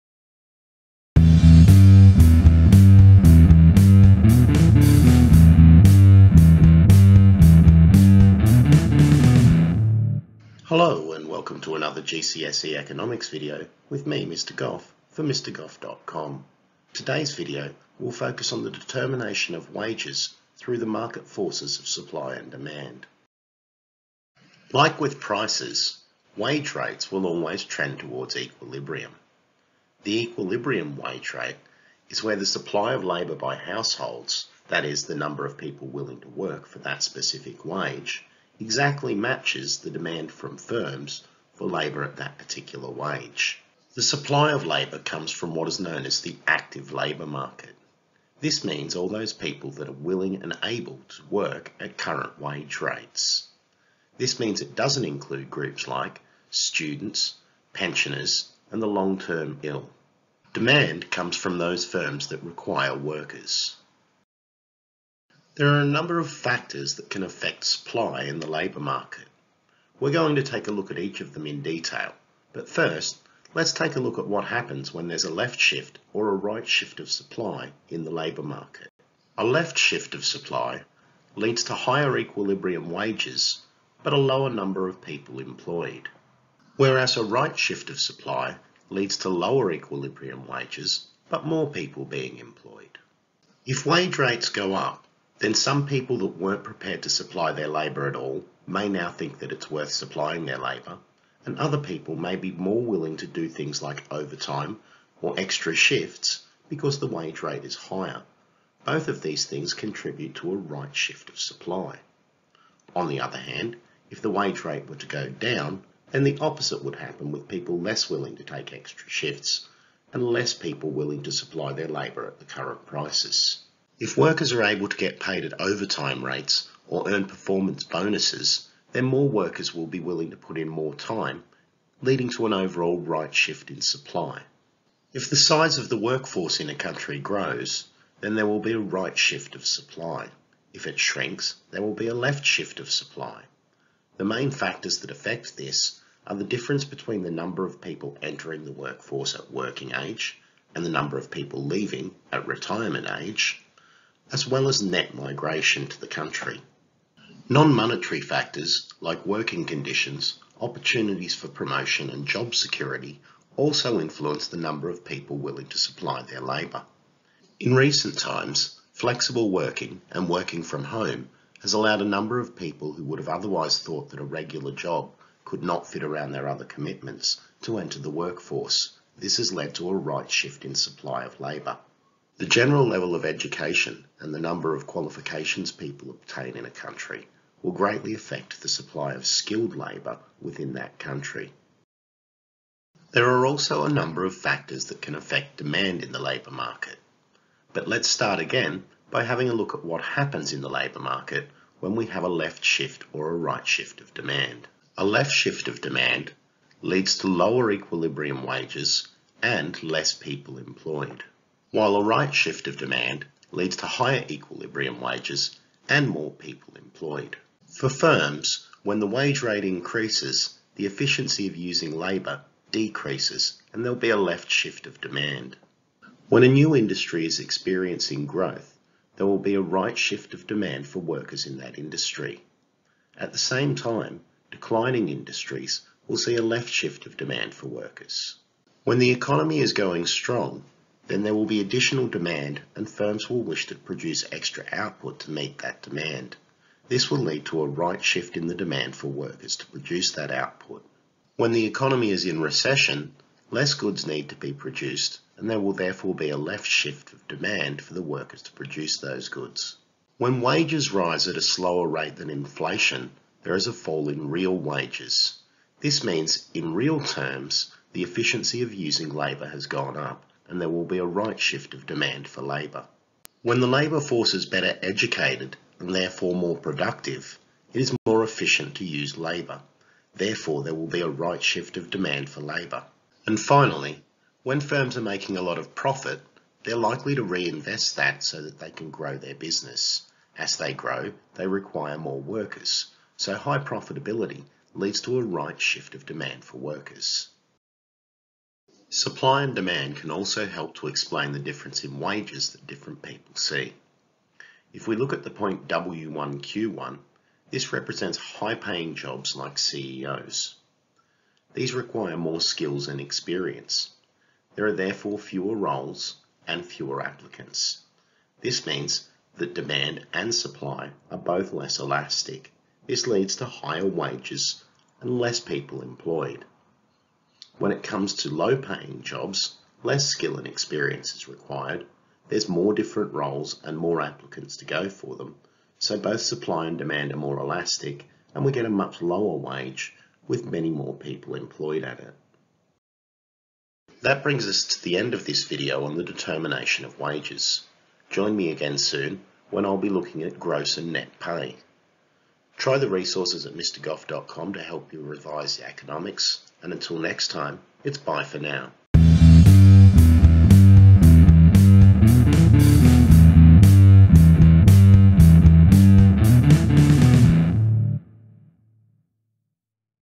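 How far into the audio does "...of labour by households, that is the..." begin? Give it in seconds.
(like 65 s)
32 s.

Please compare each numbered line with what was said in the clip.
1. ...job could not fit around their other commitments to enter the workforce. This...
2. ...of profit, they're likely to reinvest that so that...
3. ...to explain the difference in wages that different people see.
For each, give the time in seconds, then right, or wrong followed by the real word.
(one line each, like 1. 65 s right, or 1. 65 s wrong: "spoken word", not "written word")
1. 174 s right
2. 285 s right
3. 300 s right.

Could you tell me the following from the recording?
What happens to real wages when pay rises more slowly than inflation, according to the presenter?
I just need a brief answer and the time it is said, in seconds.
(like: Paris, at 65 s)
a fall, at 263 s.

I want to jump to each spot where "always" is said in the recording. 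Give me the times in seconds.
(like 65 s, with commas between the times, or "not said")
27 s.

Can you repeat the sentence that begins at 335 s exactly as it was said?
So both supply and demand are more elastic and we get a much lower wage with many more people employed at it.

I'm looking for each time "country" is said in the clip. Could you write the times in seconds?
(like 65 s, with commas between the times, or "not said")
136 s, 156 s, 186 s, 190 s.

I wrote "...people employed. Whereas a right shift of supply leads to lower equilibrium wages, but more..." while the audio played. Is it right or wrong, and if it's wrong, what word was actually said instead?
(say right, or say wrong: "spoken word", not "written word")
right.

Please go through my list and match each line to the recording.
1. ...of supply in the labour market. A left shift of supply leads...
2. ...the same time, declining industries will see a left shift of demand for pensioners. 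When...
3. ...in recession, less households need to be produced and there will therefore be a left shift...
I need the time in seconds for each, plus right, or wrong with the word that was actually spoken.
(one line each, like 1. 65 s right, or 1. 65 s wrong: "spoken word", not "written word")
1. 76 s right
2. 233 s wrong: "workers", not "pensioners"
3. 252 s wrong: "goods", not "households".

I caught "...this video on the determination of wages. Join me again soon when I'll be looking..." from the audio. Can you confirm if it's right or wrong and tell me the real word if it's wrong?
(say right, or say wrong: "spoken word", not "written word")
right.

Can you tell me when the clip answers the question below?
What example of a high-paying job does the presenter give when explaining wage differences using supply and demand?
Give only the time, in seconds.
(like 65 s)
309 s.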